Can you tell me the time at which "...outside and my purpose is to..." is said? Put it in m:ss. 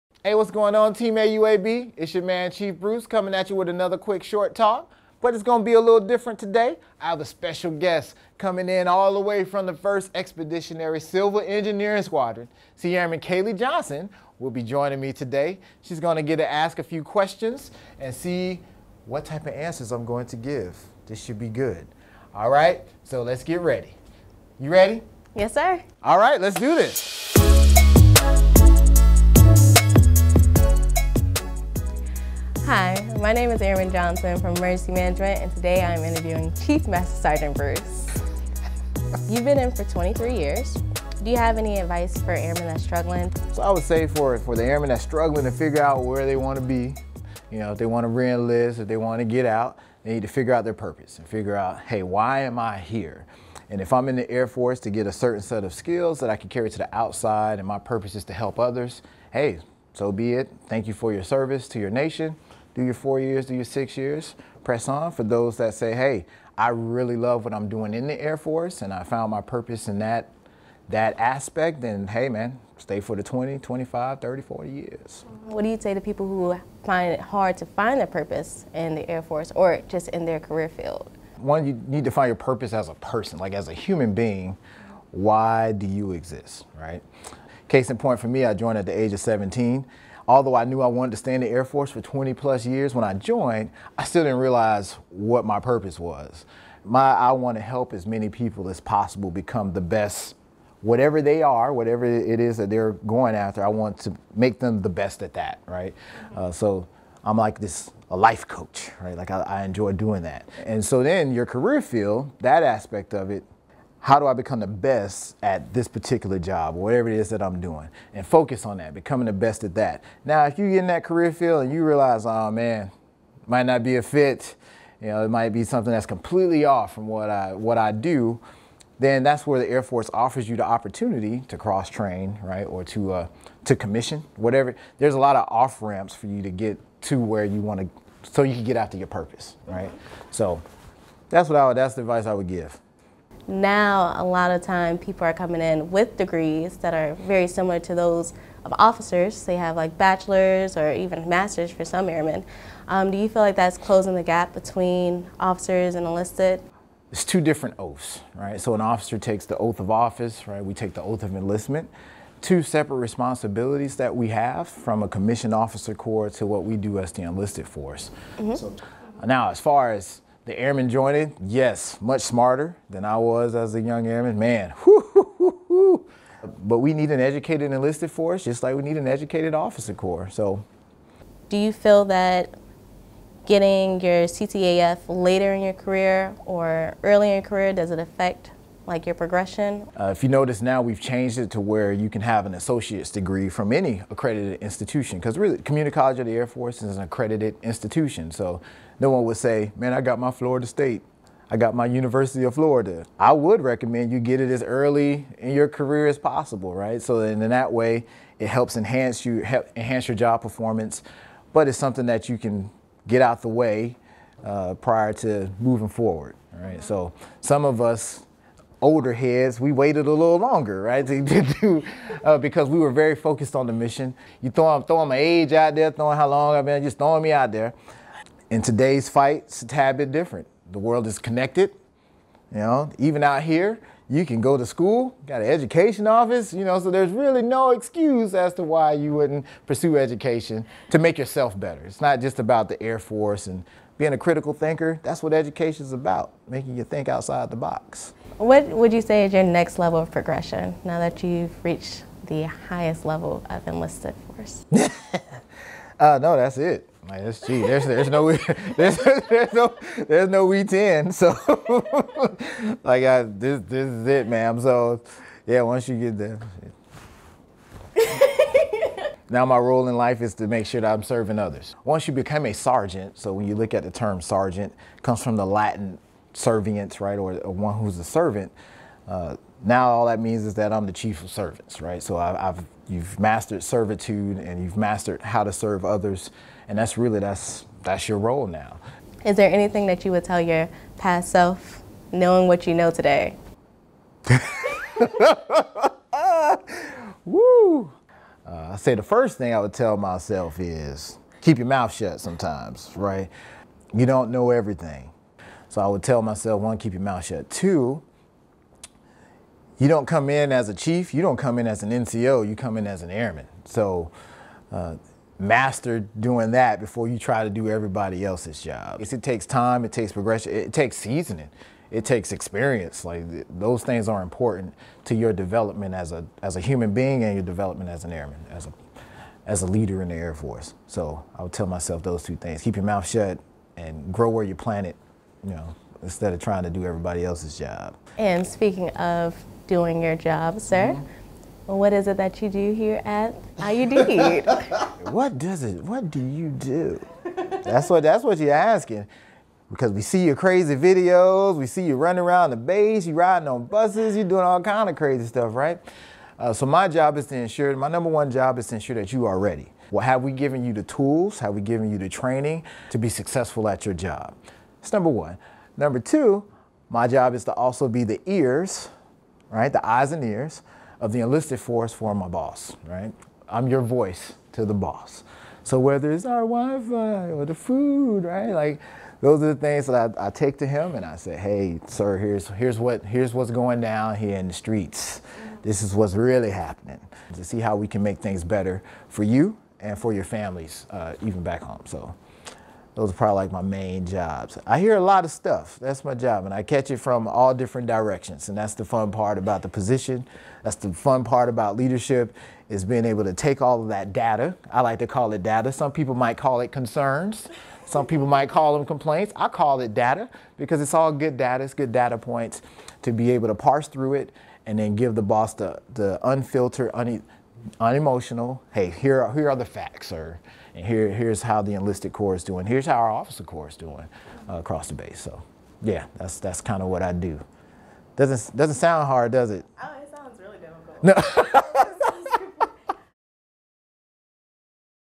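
0:56.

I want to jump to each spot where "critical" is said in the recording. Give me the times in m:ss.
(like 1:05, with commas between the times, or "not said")
4:04.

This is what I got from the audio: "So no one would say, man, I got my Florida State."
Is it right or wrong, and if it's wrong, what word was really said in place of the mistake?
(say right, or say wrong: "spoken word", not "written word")
right.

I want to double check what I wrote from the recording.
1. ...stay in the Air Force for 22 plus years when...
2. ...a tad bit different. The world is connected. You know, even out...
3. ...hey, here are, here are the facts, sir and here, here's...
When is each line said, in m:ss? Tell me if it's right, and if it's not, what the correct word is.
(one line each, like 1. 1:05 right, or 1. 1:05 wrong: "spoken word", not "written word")
1. 1:31 wrong: "20", not "22"
2. 3:49 right
3. 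6:58 right.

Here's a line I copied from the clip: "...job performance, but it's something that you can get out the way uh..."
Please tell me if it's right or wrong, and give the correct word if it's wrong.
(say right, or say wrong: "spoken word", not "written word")
right.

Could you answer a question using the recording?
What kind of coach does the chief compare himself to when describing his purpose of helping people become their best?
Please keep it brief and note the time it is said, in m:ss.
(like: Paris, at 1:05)
life coach, at 1:48.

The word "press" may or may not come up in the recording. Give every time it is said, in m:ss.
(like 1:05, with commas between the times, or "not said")
1:04.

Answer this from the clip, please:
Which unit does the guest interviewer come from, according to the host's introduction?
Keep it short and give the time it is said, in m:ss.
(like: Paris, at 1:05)
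1st Expeditionary Civil Engineering Squadron, at 0:09.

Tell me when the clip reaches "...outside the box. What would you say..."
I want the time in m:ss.
4:07.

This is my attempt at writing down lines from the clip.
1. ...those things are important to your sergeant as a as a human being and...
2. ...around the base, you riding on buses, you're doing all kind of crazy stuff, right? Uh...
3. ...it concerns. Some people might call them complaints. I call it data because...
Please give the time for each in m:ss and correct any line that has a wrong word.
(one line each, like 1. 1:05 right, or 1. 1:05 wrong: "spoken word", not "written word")
1. 5:23 wrong: "development", not "sergeant"
2. 5:52 right
3. 6:46 right.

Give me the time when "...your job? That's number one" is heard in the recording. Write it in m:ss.
6:03.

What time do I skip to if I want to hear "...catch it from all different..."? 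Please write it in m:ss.
6:36.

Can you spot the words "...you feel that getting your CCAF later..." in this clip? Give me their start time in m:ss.
3:01.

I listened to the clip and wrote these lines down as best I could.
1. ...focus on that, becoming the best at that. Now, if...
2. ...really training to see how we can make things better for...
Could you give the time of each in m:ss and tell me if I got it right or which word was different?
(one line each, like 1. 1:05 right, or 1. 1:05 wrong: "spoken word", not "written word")
1. 1:58 right
2. 6:26 wrong: "happening", not "training".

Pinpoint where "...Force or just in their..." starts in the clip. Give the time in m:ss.
1:19.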